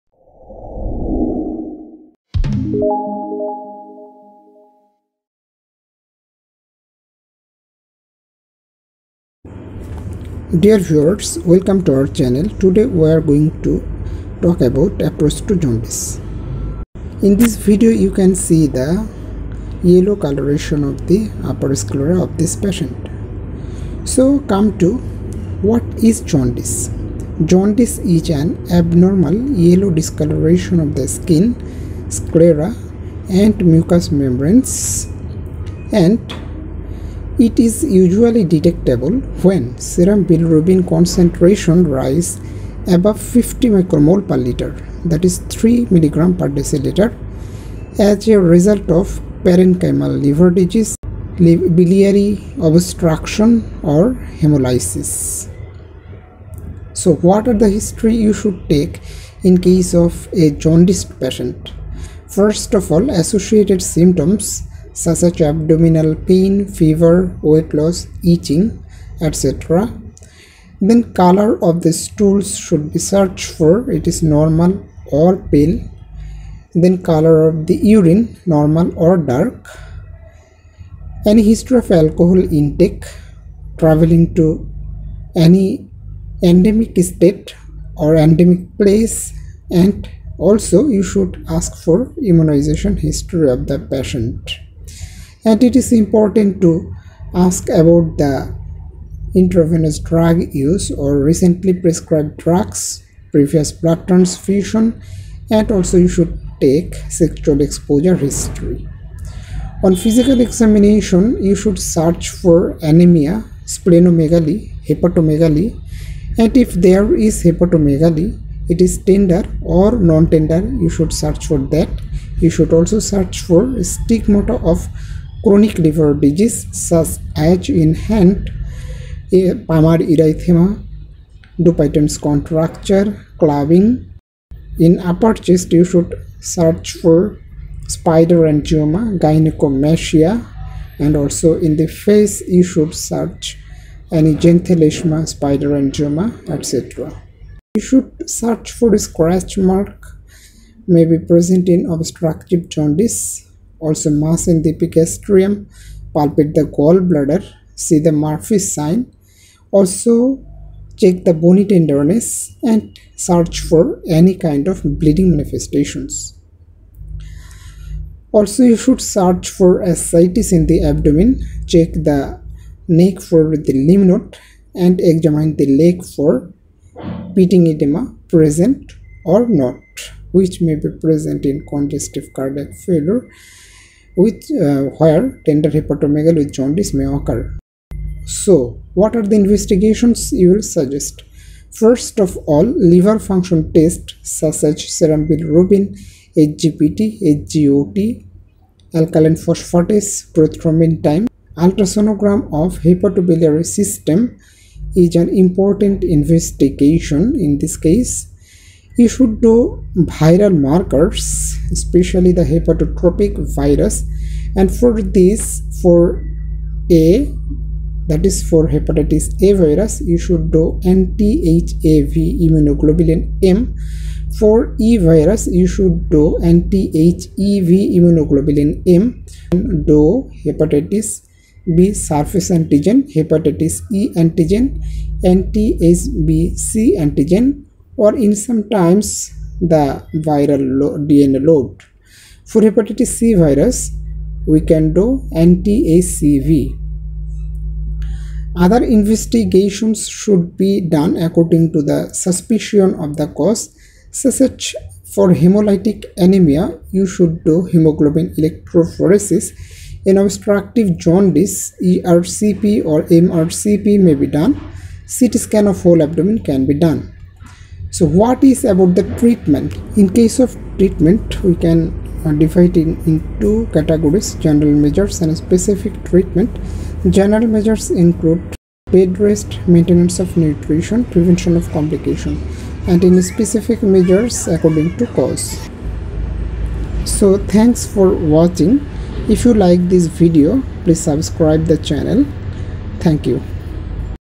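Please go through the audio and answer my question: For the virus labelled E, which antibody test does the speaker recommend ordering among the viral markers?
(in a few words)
anti-HEV immunoglobulin M.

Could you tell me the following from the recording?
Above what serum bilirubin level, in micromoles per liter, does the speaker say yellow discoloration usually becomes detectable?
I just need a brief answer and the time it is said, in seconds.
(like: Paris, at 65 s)
50 micromole per liter, at 43 s.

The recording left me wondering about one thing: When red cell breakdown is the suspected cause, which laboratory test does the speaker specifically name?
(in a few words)
hemoglobin electrophoresis.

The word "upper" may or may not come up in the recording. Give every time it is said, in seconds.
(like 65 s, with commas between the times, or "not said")
21 s, 135 s.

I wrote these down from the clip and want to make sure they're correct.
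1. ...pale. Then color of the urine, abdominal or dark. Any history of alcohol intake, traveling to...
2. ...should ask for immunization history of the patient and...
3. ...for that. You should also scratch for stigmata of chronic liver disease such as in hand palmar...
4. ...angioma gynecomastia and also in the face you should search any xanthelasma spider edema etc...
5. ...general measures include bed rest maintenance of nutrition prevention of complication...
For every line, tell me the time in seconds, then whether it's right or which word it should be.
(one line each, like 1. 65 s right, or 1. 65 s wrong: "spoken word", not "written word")
1. 75 s wrong: "normal", not "abdominal"
2. 91 s right
3. 121 s wrong: "search", not "scratch"
4. 138 s wrong: "angioma", not "edema"
5. 277 s right.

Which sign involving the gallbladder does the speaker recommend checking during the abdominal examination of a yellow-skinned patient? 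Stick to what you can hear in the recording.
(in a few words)
Murphy's sign.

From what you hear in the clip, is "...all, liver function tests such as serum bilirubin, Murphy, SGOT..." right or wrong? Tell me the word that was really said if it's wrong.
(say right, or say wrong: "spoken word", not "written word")
wrong: "SGPT", not "Murphy".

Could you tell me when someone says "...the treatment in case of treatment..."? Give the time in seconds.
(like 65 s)
268 s.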